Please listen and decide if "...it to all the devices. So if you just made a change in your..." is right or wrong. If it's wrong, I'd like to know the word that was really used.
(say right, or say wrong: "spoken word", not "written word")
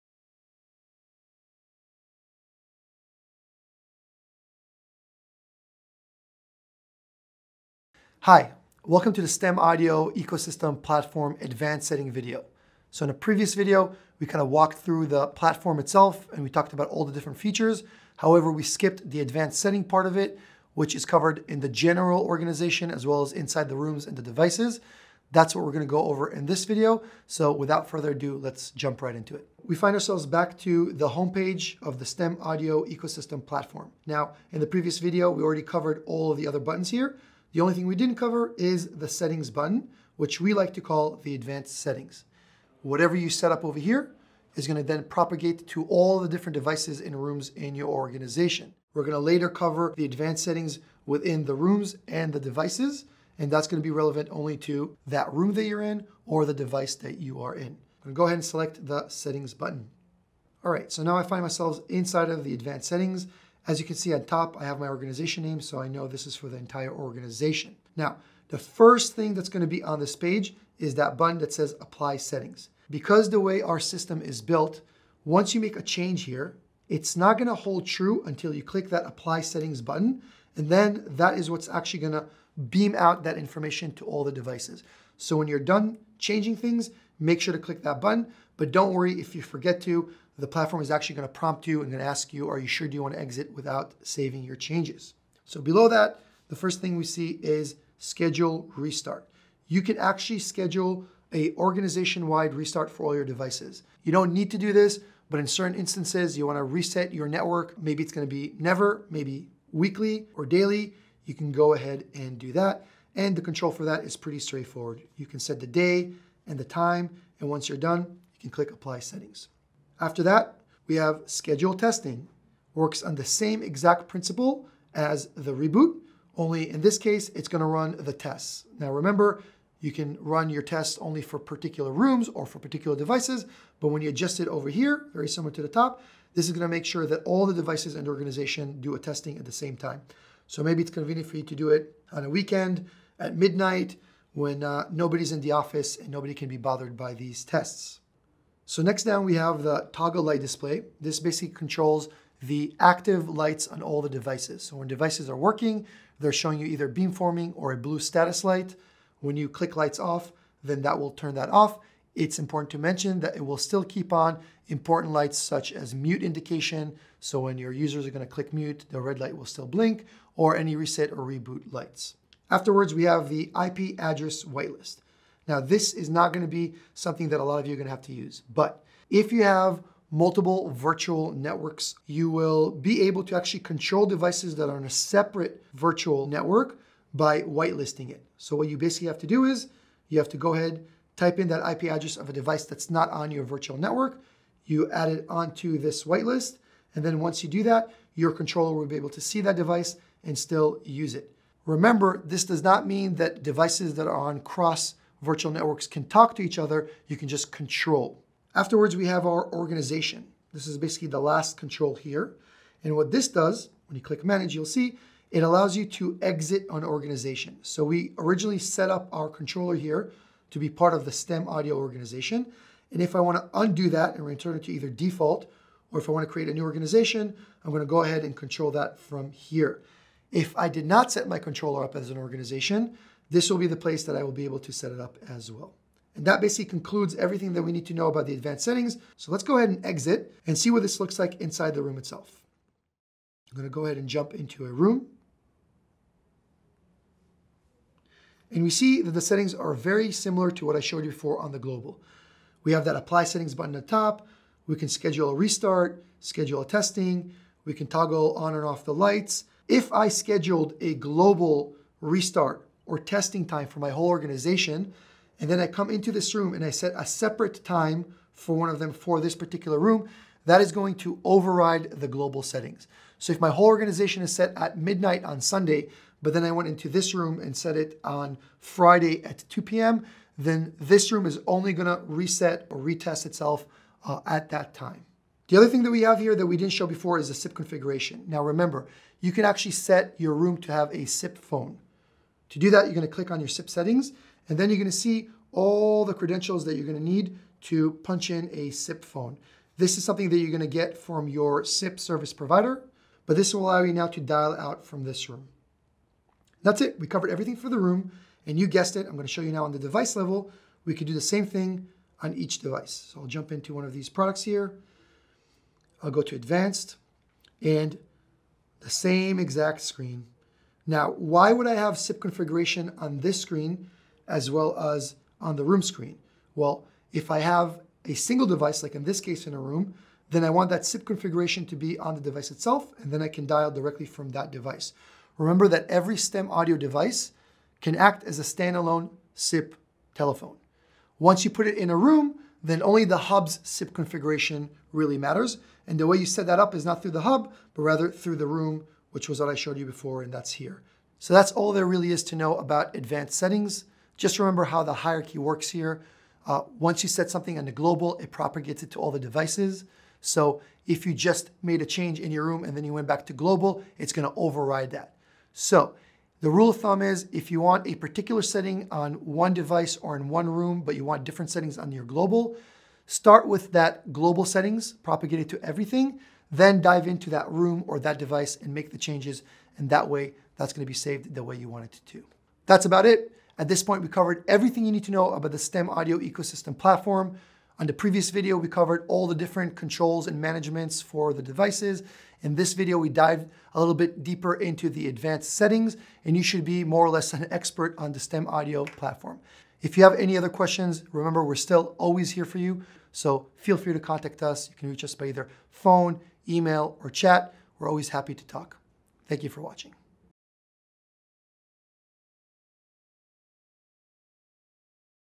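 right.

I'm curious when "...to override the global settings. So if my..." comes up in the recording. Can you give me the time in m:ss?
4:30.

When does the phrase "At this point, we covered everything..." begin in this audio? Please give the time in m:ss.
6:23.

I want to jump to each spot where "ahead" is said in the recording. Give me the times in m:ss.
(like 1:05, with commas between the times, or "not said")
0:58, 1:51, 3:10, 3:48, 3:59, 4:03.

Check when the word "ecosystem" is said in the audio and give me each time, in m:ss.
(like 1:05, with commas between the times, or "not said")
0:10, 0:32, 6:26.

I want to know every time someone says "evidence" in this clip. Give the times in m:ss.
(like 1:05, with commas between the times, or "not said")
not said.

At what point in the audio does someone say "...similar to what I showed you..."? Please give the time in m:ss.
4:10.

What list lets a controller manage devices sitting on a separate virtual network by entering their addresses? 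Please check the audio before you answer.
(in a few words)
IP address whitelist.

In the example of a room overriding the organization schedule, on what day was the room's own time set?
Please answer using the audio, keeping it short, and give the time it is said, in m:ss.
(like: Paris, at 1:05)
Friday, at 4:38.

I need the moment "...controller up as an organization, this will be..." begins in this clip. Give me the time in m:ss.
3:51.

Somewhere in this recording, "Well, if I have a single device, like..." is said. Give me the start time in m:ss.
5:26.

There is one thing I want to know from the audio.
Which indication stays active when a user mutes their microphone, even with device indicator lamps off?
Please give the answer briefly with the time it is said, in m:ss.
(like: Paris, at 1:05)
mute indication, at 2:45.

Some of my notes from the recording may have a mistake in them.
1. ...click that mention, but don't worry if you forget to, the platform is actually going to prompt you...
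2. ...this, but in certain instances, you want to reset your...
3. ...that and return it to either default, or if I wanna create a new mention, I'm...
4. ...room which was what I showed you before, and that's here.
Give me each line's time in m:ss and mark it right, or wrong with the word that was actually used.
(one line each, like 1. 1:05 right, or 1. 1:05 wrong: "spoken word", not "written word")
1. 1:27 wrong: "button", not "mention"
2. 1:44 right
3. 3:43 wrong: "organization", not "mention"
4. 5:48 right.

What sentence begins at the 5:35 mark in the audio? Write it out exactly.
Remember that every STEM audio device can act as a standalone SIP telephone.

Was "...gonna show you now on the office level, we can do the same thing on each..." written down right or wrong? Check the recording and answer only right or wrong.
wrong.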